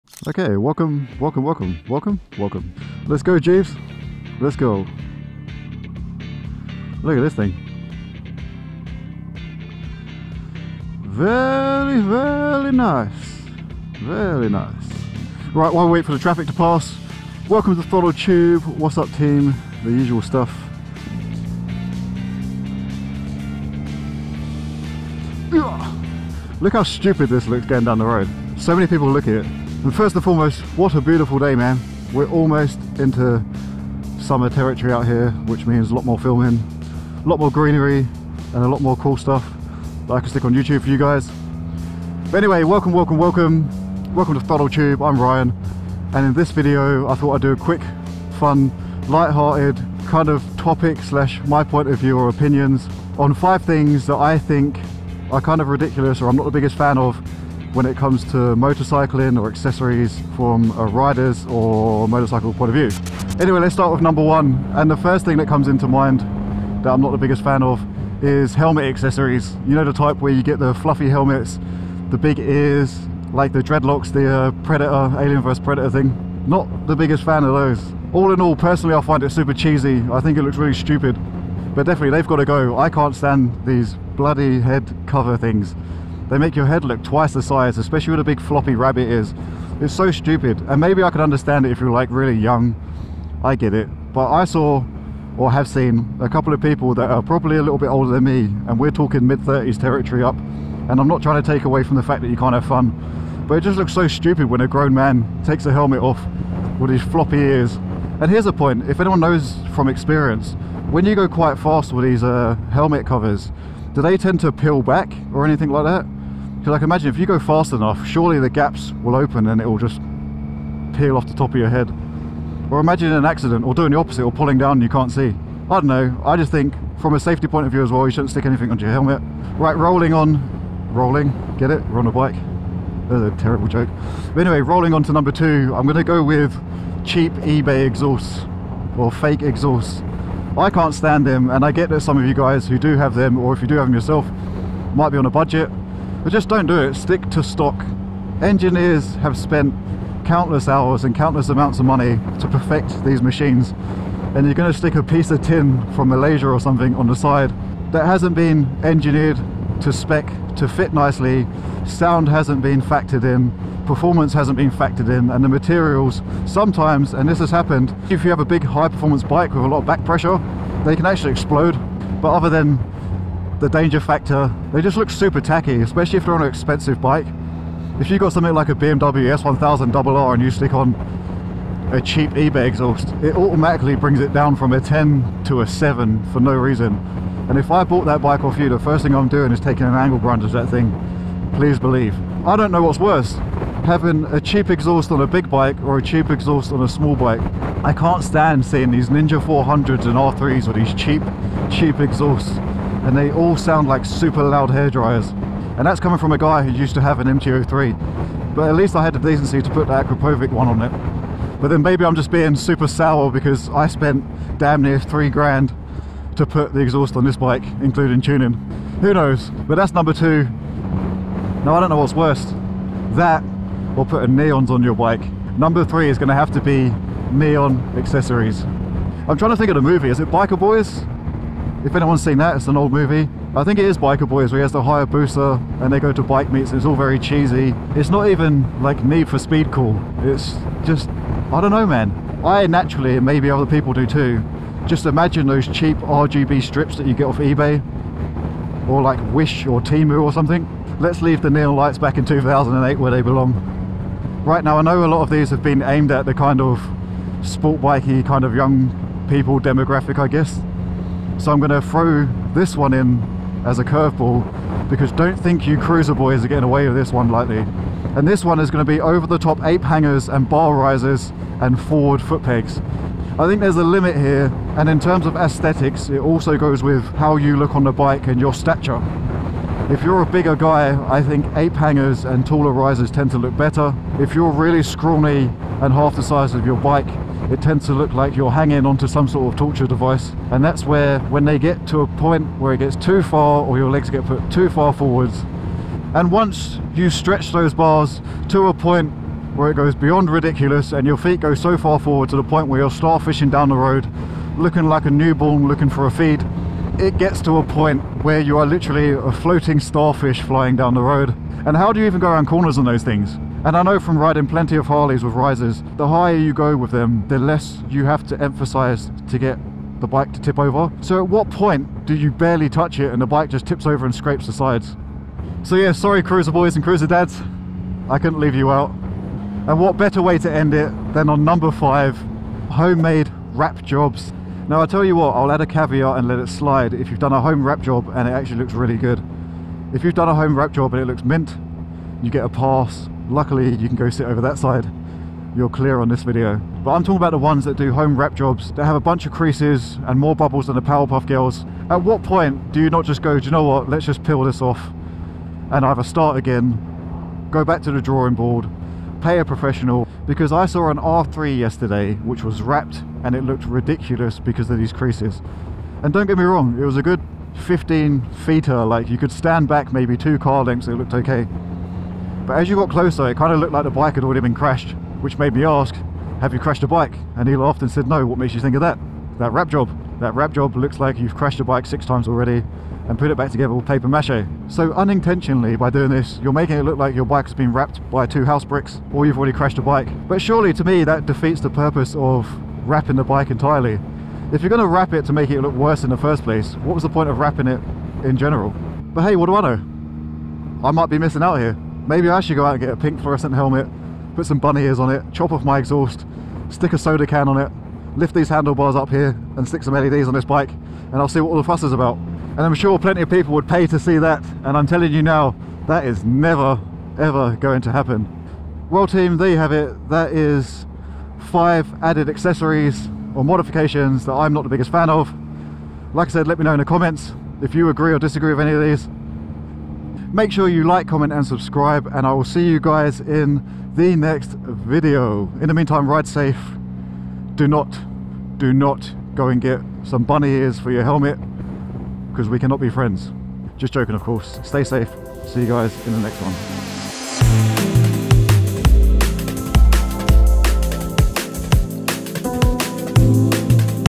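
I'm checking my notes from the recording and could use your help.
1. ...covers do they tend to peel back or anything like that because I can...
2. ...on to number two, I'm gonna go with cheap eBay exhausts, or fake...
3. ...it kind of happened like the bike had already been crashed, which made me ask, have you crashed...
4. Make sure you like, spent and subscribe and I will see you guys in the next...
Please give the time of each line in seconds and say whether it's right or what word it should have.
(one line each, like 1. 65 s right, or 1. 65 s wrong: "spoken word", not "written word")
1. 113 s right
2. 134 s right
3. 373 s wrong: "looked", not "happened"
4. 430 s wrong: "comment", not "spent".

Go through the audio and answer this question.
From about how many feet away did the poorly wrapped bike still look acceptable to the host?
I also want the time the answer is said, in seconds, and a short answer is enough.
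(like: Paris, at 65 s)
15 feet, at 367 s.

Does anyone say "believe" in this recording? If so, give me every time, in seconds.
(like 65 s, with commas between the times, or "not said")
191 s.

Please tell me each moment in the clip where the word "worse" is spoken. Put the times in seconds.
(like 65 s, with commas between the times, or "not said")
192 s, 222 s, 395 s.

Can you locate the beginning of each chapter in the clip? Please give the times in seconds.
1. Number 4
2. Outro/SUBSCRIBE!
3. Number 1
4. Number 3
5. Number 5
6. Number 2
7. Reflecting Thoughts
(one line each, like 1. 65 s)
1. 268 s
2. 430 s
3. 68 s
4. 226 s
5. 332 s
6. 136 s
7. 398 s.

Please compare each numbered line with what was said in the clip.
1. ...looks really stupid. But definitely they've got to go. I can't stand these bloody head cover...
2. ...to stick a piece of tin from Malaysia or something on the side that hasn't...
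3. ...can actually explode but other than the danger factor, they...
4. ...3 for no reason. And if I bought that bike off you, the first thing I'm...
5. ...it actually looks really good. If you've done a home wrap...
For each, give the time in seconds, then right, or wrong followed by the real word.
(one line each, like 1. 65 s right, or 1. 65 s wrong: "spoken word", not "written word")
1. 80 s right
2. 154 s right
3. 170 s right
4. 185 s wrong: "7", not "3"
5. 338 s right.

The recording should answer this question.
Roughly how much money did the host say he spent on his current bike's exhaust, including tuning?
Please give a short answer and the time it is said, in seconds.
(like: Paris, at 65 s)
3 grand, at 214 s.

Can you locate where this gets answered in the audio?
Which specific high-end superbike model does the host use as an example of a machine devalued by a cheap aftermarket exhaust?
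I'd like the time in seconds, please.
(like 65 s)
178 s.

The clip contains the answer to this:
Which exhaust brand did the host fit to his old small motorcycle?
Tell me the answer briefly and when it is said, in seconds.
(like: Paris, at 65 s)
Akrapovic, at 209 s.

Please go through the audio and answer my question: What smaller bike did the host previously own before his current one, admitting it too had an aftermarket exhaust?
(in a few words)
MT-03.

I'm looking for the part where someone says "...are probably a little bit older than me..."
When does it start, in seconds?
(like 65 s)
97 s.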